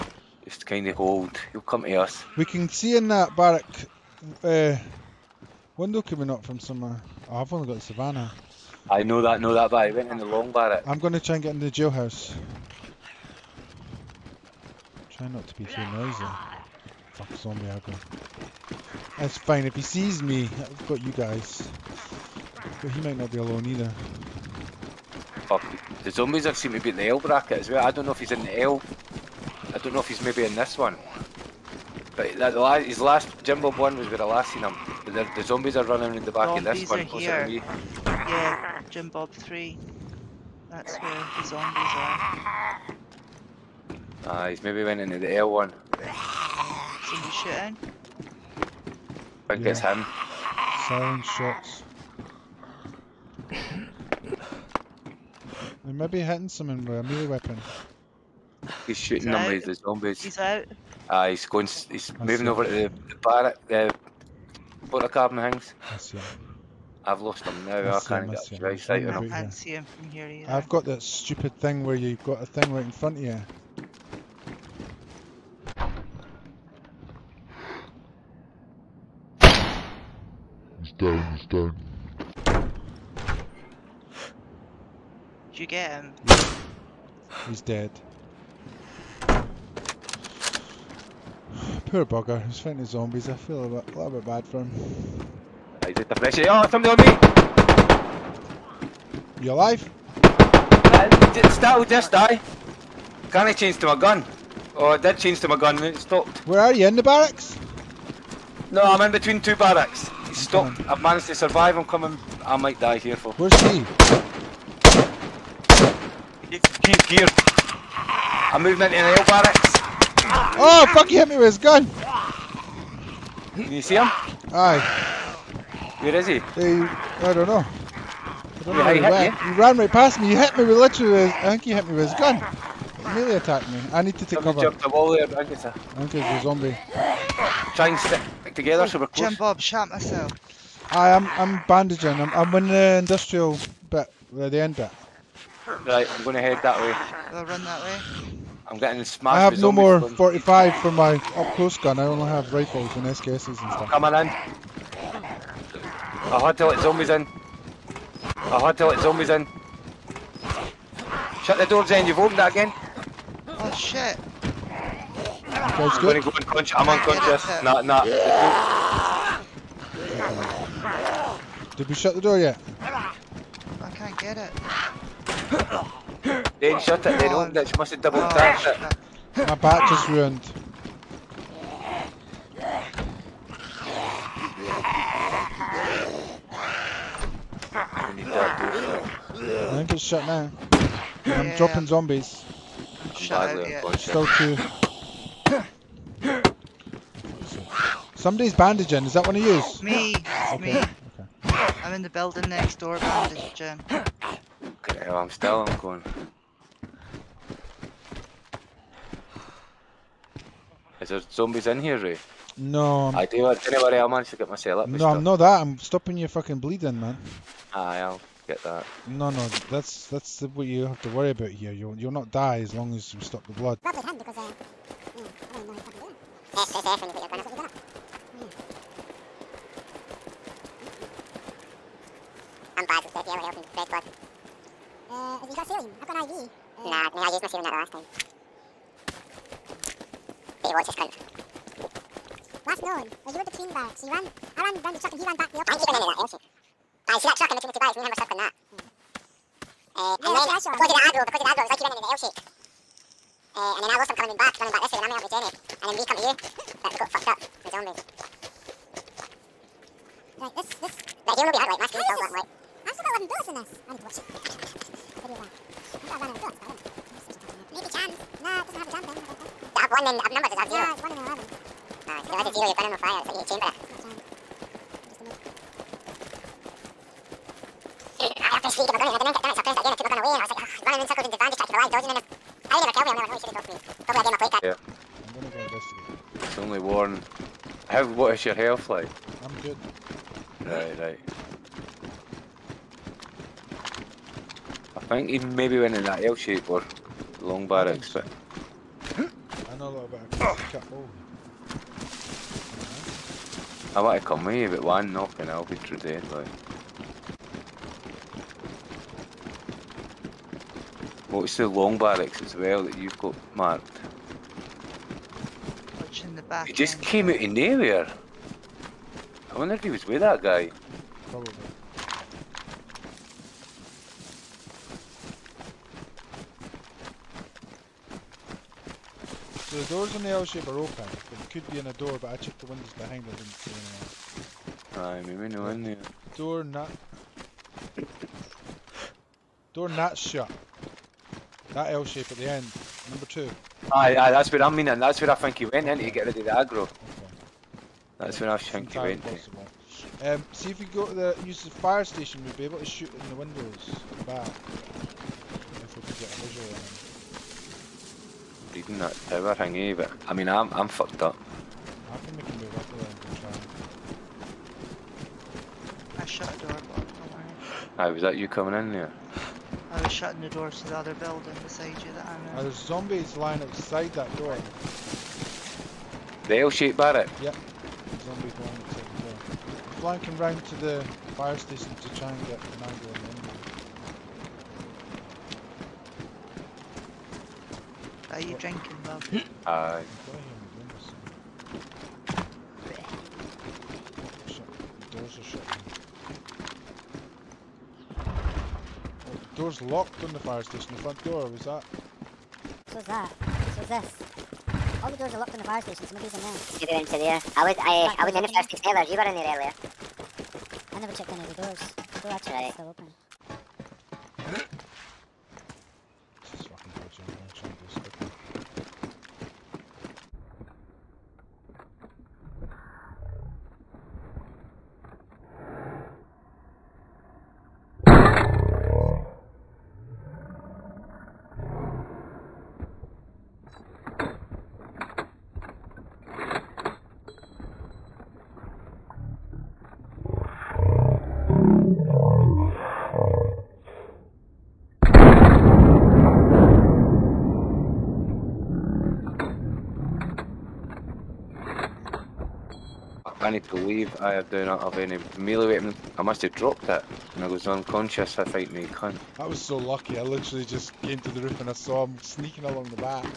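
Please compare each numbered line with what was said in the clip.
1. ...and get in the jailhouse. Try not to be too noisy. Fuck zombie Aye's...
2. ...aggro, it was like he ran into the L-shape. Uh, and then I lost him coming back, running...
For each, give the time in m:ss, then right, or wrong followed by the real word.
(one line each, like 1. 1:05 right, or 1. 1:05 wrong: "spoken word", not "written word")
1. 0:11 wrong: "That", not "Aye"
2. 4:11 right.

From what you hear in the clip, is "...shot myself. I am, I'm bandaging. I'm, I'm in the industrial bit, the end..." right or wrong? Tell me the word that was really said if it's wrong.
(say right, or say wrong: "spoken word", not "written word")
right.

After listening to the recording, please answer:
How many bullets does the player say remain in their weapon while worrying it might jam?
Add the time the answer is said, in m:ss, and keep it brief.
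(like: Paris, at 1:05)
11, at 4:22.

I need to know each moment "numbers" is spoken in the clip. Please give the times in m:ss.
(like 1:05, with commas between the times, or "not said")
4:30, 5:43.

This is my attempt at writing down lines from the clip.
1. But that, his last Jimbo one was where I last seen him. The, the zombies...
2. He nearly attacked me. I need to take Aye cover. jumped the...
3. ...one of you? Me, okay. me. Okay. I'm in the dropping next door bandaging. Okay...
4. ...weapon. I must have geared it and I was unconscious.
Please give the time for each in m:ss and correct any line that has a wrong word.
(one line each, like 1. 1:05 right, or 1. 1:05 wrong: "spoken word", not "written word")
1. 0:32 right
2. 2:12 wrong: "Somebody", not "Aye"
3. 3:19 wrong: "building", not "dropping"
4. 7:35 wrong: "dropped", not "geared".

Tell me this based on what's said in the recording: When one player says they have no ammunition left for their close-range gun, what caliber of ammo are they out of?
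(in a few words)
45.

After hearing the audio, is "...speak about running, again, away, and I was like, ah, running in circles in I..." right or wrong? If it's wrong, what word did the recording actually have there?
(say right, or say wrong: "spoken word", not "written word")
right.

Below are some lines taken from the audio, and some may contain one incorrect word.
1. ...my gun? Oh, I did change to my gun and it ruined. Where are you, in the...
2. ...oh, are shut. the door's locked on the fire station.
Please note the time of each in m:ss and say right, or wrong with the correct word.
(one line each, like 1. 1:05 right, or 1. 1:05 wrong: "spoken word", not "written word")
1. 1:43 wrong: "stopped", not "ruined"
2. 6:35 right.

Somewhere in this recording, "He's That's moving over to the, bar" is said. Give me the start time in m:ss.
1:01.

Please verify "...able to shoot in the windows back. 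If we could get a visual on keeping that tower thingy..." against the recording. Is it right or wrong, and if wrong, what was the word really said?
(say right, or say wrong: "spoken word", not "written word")
wrong: "leading", not "keeping".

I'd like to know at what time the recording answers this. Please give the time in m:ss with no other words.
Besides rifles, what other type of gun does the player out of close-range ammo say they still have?
2:31.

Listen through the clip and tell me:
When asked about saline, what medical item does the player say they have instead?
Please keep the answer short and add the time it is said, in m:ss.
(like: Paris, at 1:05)
IV, at 3:56.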